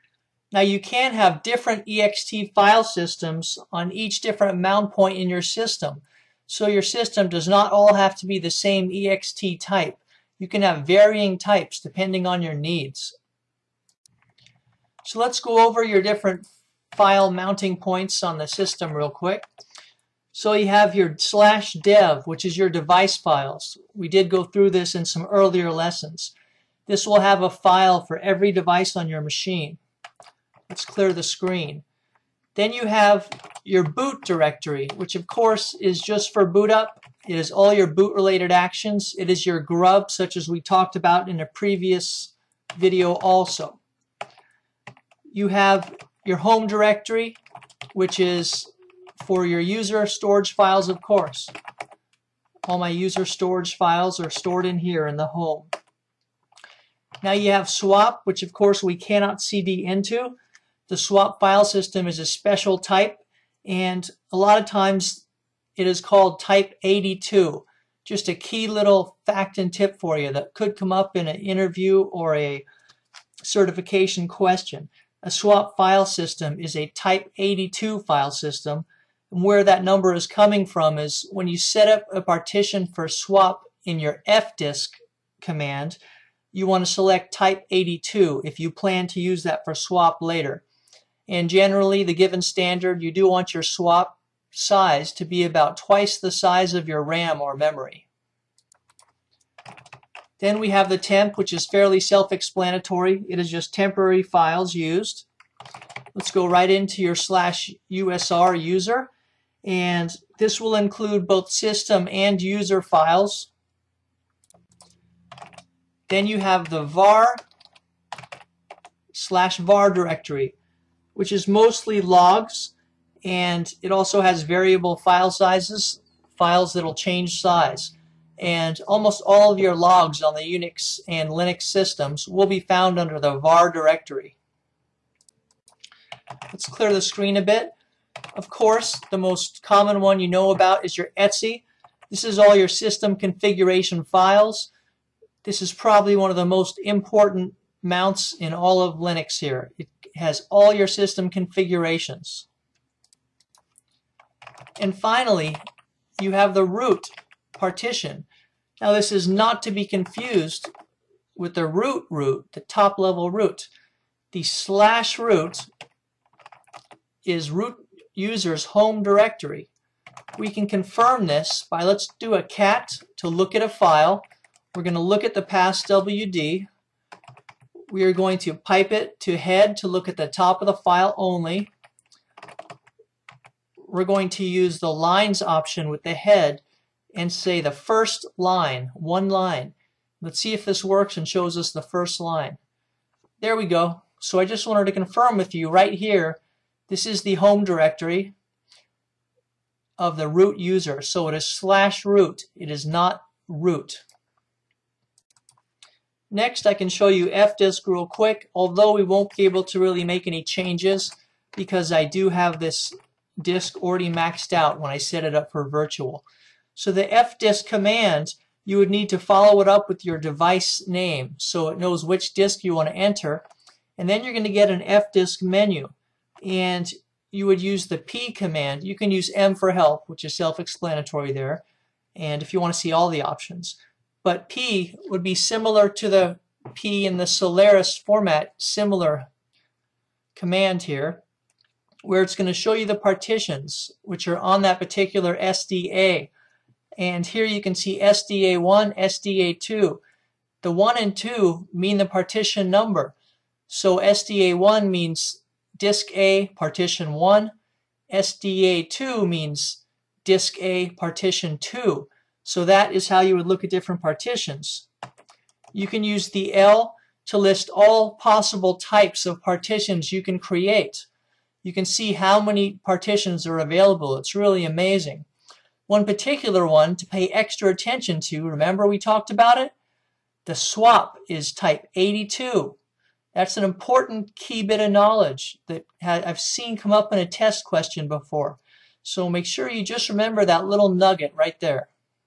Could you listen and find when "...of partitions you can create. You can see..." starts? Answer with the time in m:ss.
4:29.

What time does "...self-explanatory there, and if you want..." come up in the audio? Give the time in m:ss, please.
3:50.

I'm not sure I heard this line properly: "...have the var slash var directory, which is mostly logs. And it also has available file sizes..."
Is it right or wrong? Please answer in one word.
wrong.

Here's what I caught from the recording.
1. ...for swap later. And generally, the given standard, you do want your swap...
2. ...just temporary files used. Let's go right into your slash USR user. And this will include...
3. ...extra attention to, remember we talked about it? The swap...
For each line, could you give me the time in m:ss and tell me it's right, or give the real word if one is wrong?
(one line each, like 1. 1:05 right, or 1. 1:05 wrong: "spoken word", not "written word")
1. 1:29 right
2. 1:43 right
3. 4:37 right.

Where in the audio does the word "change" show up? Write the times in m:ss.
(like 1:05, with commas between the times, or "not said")
2:06, 3:30.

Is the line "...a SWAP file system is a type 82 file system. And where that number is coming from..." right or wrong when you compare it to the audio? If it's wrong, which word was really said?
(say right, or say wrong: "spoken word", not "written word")
right.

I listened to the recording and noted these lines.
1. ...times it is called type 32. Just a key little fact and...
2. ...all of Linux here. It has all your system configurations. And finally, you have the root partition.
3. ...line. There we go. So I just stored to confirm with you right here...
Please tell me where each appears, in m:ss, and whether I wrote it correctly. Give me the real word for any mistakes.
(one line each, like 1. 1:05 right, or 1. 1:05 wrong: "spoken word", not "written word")
1. 1:04 wrong: "82", not "32"
2. 2:28 right
3. 3:12 wrong: "wanted", not "stored".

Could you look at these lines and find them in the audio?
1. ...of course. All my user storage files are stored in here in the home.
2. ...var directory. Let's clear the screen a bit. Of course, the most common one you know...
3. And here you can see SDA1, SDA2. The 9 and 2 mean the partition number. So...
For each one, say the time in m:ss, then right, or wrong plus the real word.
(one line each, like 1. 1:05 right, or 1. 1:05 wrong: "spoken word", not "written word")
1. 0:50 right
2. 2:13 right
3. 4:06 wrong: "1", not "9".